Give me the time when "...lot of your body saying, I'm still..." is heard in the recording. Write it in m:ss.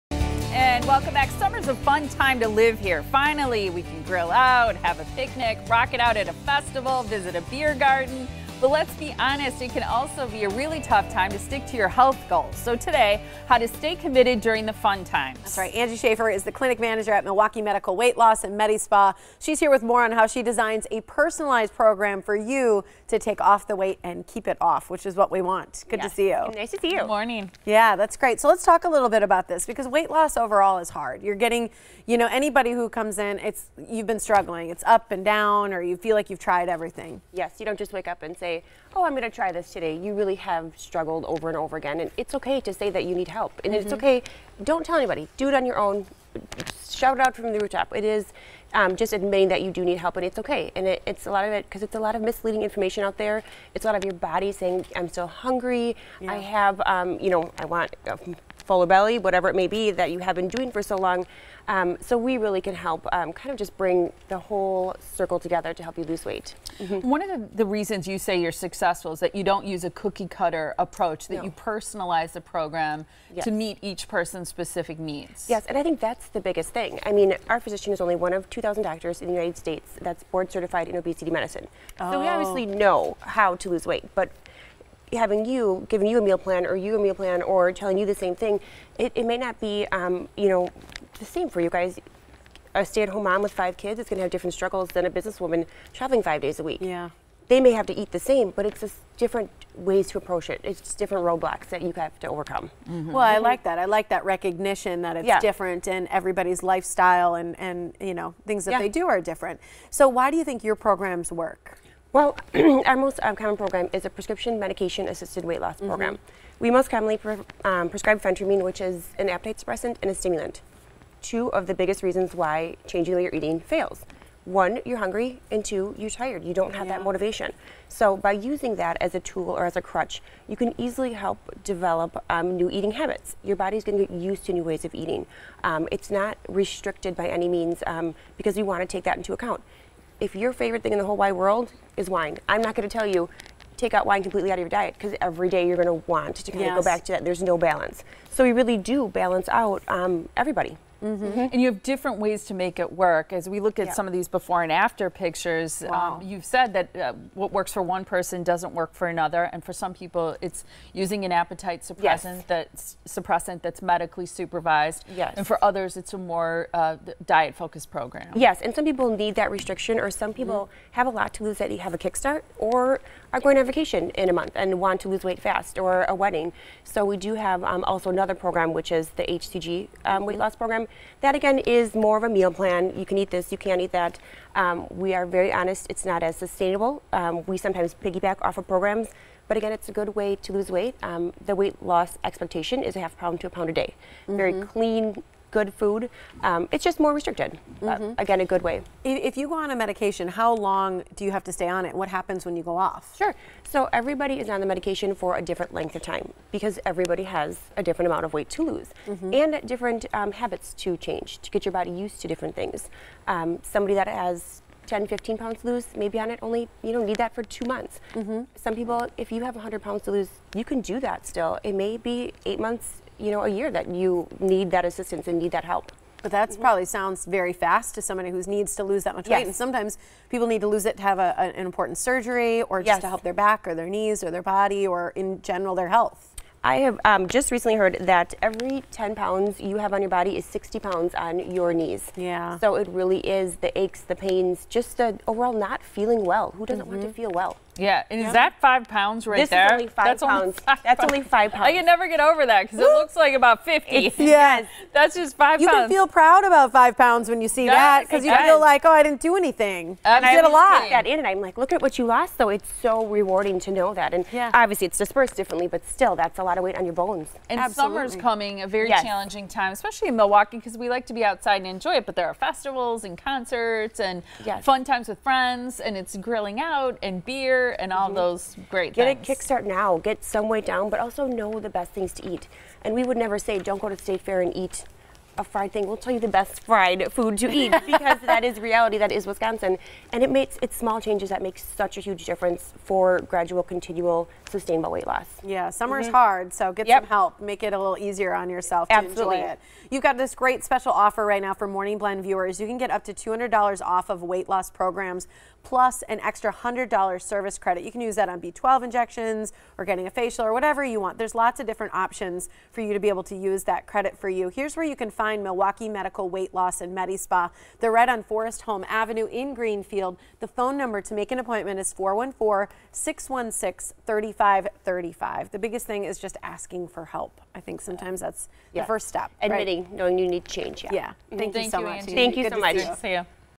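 0:53.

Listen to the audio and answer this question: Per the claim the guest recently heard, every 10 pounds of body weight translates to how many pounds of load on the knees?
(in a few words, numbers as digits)
60 pounds.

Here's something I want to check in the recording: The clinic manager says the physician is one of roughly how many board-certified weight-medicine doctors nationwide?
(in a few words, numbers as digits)
2,000.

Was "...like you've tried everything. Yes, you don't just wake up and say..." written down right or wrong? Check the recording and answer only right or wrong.
right.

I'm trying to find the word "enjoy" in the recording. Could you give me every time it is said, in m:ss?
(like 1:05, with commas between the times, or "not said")
4:31, 4:59.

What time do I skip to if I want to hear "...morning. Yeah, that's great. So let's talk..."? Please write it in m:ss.
0:27.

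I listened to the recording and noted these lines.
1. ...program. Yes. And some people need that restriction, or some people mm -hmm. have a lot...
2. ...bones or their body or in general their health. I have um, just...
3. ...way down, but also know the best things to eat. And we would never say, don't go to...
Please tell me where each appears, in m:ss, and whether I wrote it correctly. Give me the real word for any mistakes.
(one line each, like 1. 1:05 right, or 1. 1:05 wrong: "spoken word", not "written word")
1. 2:47 right
2. 3:53 wrong: "knees", not "bones"
3. 4:40 right.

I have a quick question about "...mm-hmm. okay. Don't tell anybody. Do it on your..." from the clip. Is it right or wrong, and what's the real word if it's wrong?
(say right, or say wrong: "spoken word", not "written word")
right.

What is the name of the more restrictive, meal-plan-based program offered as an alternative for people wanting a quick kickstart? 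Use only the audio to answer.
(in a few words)
HCG.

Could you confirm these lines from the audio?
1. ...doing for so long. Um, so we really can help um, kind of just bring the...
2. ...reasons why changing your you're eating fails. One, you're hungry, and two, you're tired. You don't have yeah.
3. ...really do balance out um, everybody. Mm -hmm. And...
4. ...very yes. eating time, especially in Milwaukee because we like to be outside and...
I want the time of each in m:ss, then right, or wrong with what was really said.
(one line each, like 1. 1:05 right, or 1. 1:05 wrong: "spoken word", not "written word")
1. 1:00 right
2. 2:02 right
3. 2:28 right
4. 4:28 wrong: "challenging", not "eating".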